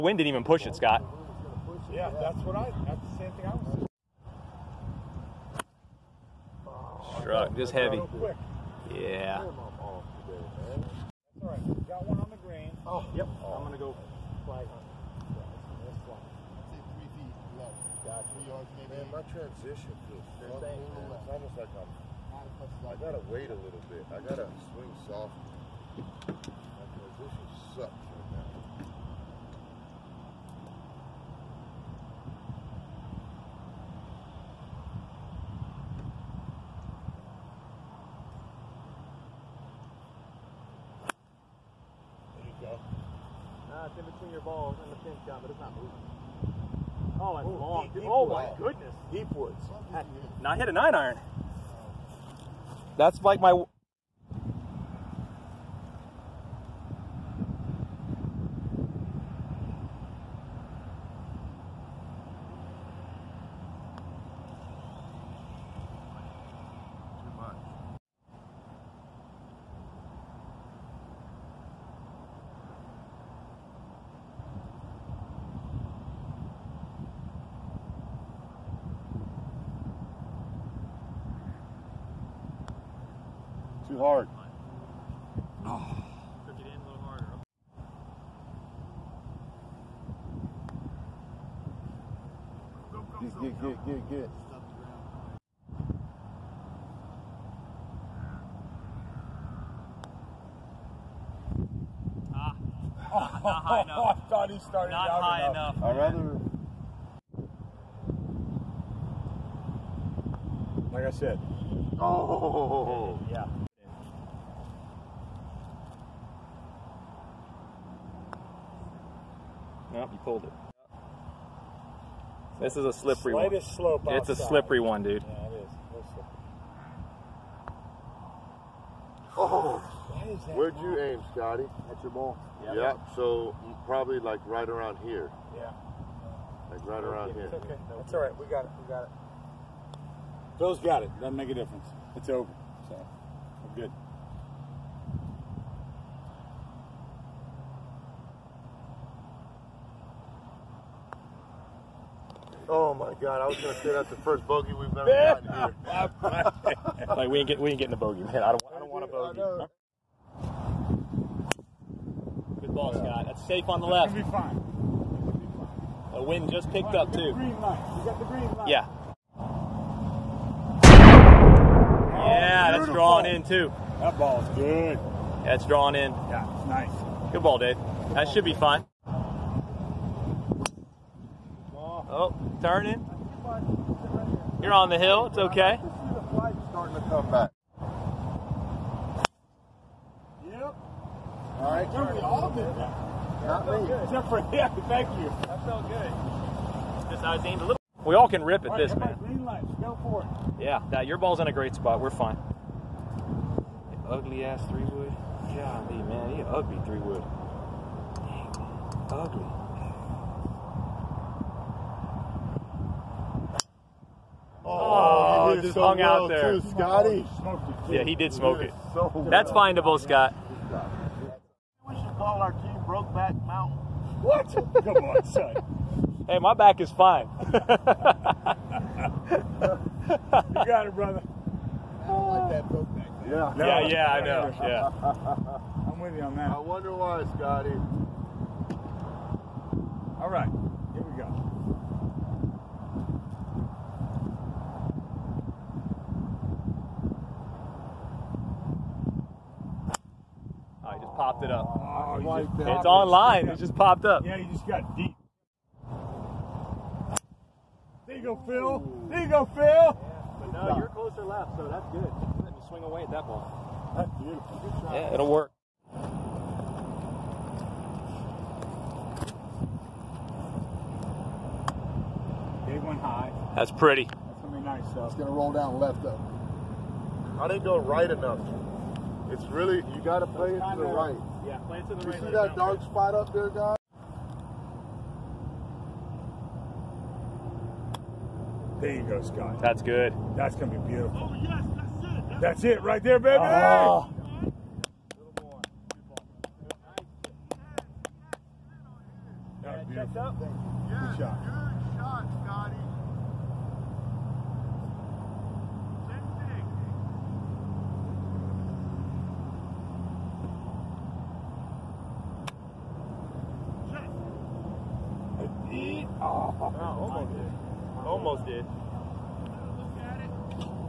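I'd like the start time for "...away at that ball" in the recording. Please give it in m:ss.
4:22.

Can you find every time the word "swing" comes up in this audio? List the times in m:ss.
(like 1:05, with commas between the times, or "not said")
0:24, 4:22.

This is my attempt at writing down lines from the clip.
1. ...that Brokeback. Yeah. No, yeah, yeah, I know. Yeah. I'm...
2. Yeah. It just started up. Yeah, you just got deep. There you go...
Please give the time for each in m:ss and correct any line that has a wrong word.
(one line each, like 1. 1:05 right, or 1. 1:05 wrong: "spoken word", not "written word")
1. 3:52 right
2. 4:13 wrong: "popped", not "started".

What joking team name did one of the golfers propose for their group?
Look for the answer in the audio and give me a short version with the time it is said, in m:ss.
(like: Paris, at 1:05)
Brokeback Mountain, at 3:42.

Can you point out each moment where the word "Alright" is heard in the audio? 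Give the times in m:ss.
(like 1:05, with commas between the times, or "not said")
0:11.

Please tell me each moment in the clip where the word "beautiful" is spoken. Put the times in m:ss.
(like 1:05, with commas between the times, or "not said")
2:52, 4:24, 4:50, 4:59.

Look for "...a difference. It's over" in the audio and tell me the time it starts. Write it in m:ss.
2:21.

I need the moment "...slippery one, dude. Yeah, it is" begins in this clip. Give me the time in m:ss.
2:04.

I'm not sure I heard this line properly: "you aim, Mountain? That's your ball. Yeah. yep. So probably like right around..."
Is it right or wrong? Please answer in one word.
wrong.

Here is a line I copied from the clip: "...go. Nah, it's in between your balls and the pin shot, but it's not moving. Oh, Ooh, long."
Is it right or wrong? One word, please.
right.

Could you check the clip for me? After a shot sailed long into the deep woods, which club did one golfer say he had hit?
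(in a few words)
Nine iron.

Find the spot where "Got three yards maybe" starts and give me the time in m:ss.
0:18.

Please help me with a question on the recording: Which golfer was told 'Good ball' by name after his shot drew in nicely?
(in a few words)
Dave.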